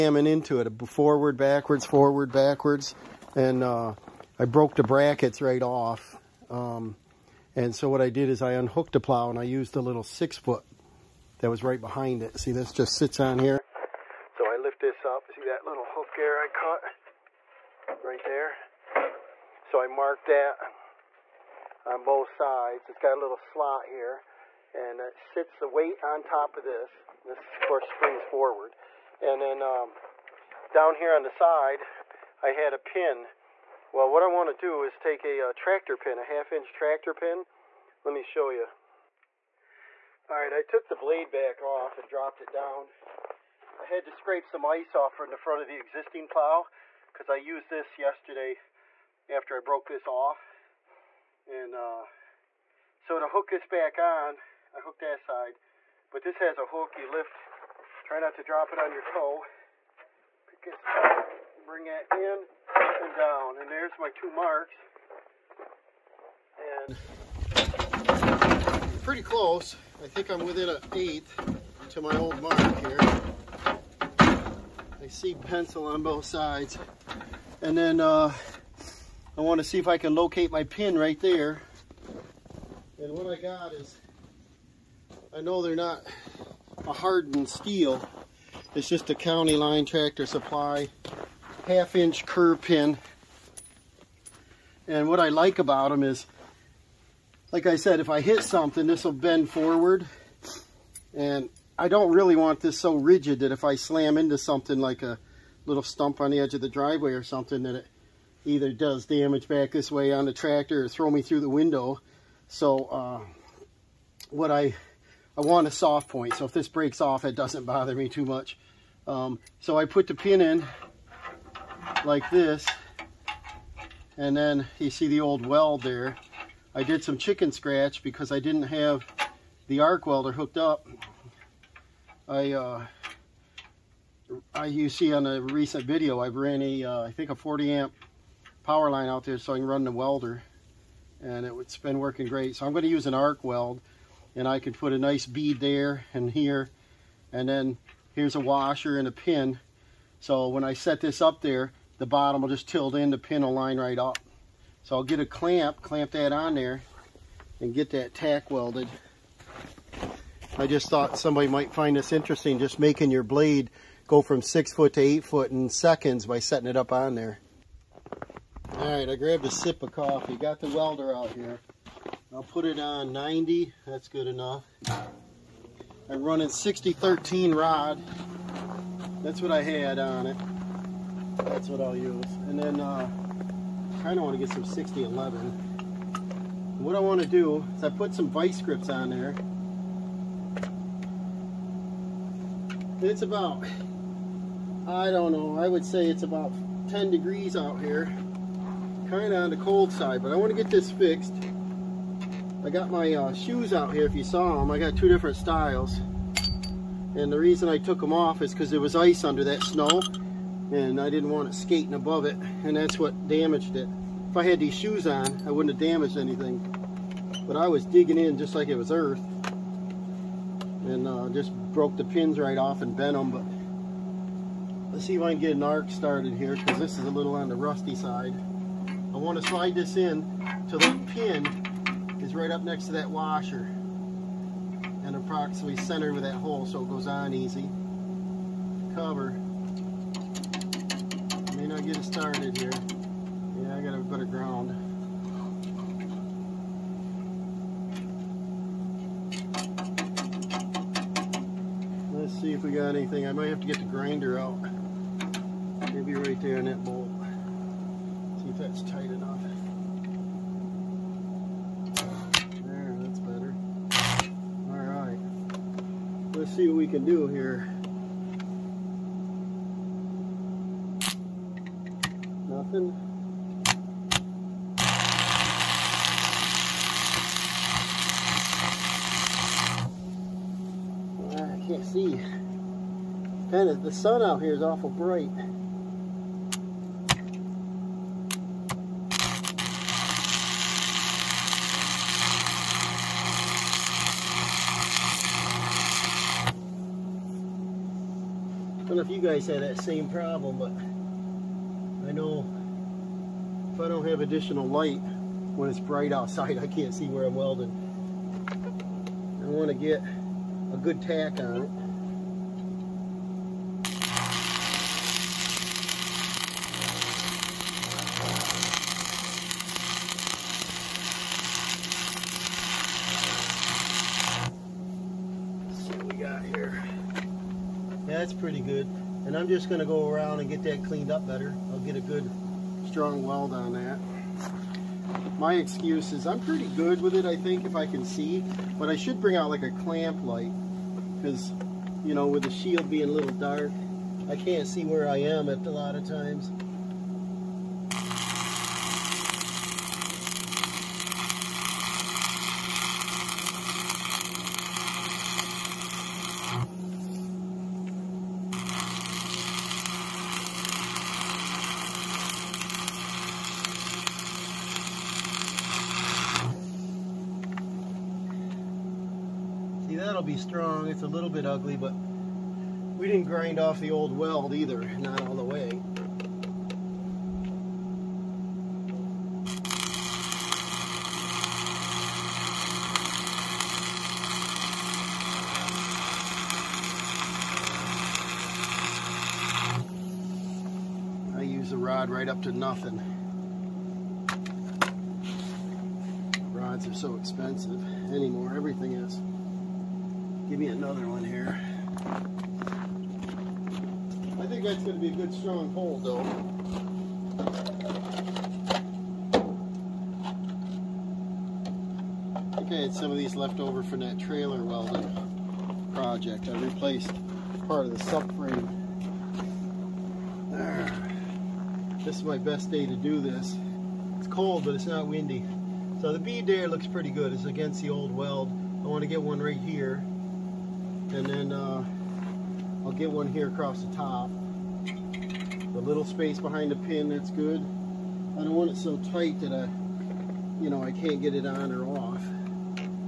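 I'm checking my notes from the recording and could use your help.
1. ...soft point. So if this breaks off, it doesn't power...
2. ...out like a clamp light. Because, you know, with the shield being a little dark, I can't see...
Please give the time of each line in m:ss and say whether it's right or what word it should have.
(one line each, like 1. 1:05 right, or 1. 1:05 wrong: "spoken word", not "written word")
1. 1:55 wrong: "bother", not "power"
2. 5:39 right.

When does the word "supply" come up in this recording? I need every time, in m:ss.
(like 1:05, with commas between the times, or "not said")
1:30.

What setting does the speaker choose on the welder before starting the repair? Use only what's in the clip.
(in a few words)
90.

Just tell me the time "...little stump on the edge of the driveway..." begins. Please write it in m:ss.
1:45.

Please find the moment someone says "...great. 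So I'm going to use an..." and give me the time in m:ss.
2:22.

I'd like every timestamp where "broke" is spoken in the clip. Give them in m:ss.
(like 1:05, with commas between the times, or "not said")
0:04, 0:49, 3:41.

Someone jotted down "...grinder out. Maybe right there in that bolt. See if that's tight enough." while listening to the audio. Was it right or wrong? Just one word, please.
right.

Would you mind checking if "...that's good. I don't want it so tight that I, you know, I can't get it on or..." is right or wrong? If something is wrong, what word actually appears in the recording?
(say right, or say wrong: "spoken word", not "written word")
right.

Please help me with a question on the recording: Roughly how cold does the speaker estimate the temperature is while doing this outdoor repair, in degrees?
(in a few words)
10 degrees.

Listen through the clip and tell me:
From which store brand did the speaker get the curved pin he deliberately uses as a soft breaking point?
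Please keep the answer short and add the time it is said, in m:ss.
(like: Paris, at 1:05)
County Line, at 1:29.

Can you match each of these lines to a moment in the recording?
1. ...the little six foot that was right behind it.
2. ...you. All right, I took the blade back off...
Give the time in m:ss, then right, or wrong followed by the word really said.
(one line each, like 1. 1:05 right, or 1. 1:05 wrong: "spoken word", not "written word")
1. 0:09 right
2. 0:38 right.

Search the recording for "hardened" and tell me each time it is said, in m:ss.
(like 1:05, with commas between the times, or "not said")
1:26.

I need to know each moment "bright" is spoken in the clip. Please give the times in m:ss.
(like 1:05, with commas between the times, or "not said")
4:44, 5:05.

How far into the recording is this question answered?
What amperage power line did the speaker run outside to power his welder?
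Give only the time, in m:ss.
2:17.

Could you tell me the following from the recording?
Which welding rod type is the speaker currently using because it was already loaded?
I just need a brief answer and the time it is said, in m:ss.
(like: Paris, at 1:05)
6013, at 2:56.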